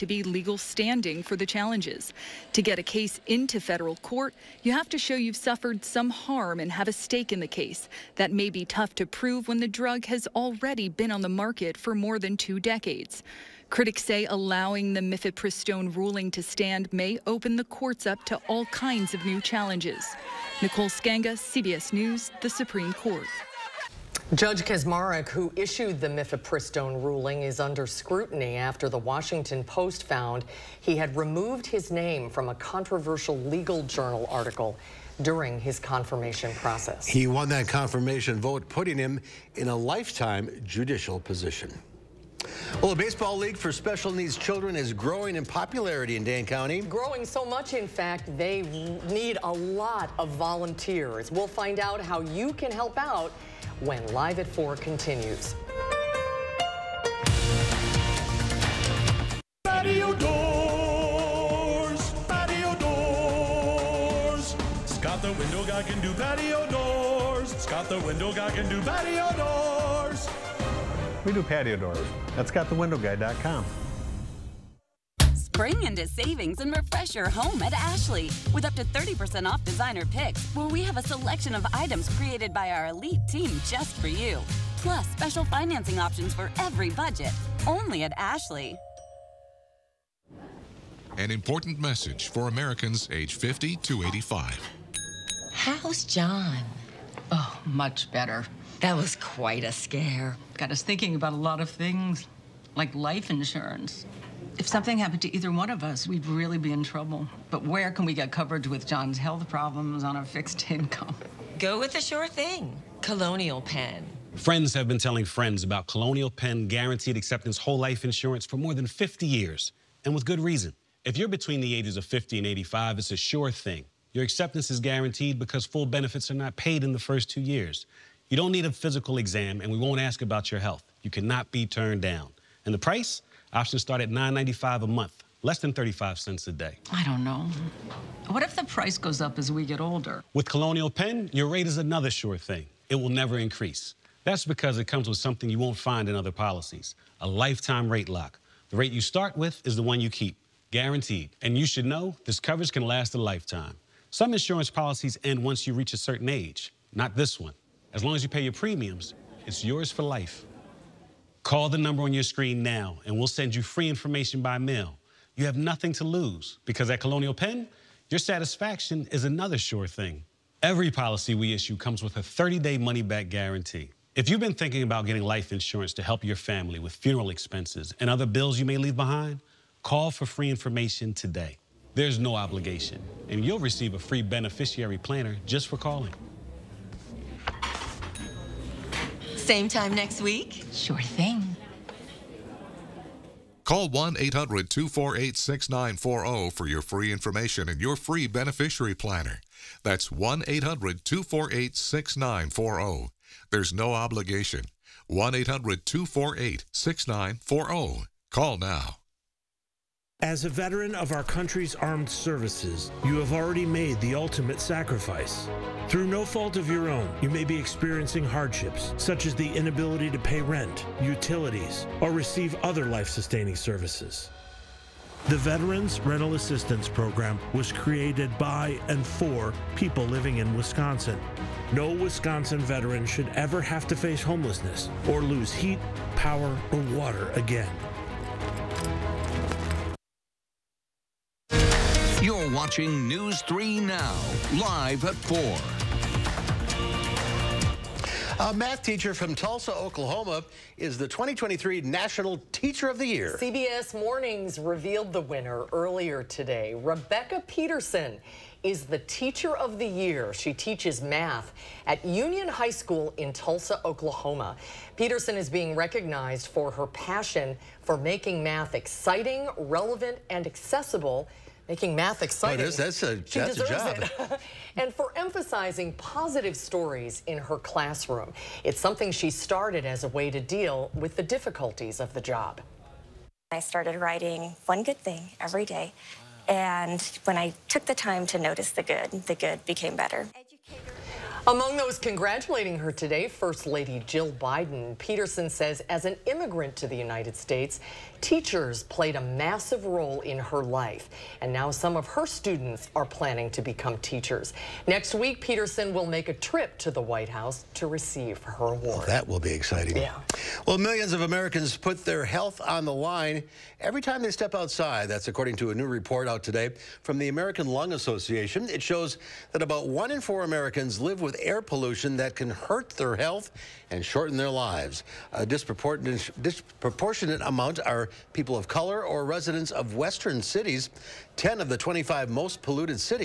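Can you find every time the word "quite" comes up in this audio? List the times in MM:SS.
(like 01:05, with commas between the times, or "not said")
01:39.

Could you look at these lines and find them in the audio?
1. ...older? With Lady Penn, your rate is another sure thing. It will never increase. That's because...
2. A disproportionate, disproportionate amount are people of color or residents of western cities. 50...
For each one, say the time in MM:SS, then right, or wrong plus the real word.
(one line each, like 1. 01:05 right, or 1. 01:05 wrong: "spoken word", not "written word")
1. 02:19 wrong: "Colonial", not "Lady"
2. 05:25 wrong: "10", not "50".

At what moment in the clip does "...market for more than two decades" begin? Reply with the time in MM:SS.
00:11.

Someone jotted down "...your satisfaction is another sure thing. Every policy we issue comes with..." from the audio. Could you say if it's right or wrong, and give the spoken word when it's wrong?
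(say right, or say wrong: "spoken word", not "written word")
right.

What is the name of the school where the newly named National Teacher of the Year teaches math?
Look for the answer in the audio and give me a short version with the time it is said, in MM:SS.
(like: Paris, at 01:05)
Union High School, at 04:22.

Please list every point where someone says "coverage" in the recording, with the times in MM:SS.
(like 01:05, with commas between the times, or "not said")
01:48, 02:32.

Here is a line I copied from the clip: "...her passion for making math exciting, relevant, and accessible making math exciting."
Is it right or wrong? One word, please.
right.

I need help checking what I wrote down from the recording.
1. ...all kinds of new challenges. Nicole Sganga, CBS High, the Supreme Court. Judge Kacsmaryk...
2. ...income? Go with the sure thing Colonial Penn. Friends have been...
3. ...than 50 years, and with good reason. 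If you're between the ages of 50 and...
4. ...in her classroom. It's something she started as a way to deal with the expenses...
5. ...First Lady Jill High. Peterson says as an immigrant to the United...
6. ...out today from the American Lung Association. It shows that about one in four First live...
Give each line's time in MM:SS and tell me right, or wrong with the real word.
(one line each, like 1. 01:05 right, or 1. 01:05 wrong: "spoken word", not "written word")
1. 00:18 wrong: "News", not "High"
2. 01:50 right
3. 01:58 right
4. 04:37 wrong: "difficulties", not "expenses"
5. 04:53 wrong: "Biden", not "High"
6. 05:16 wrong: "Americans", not "First".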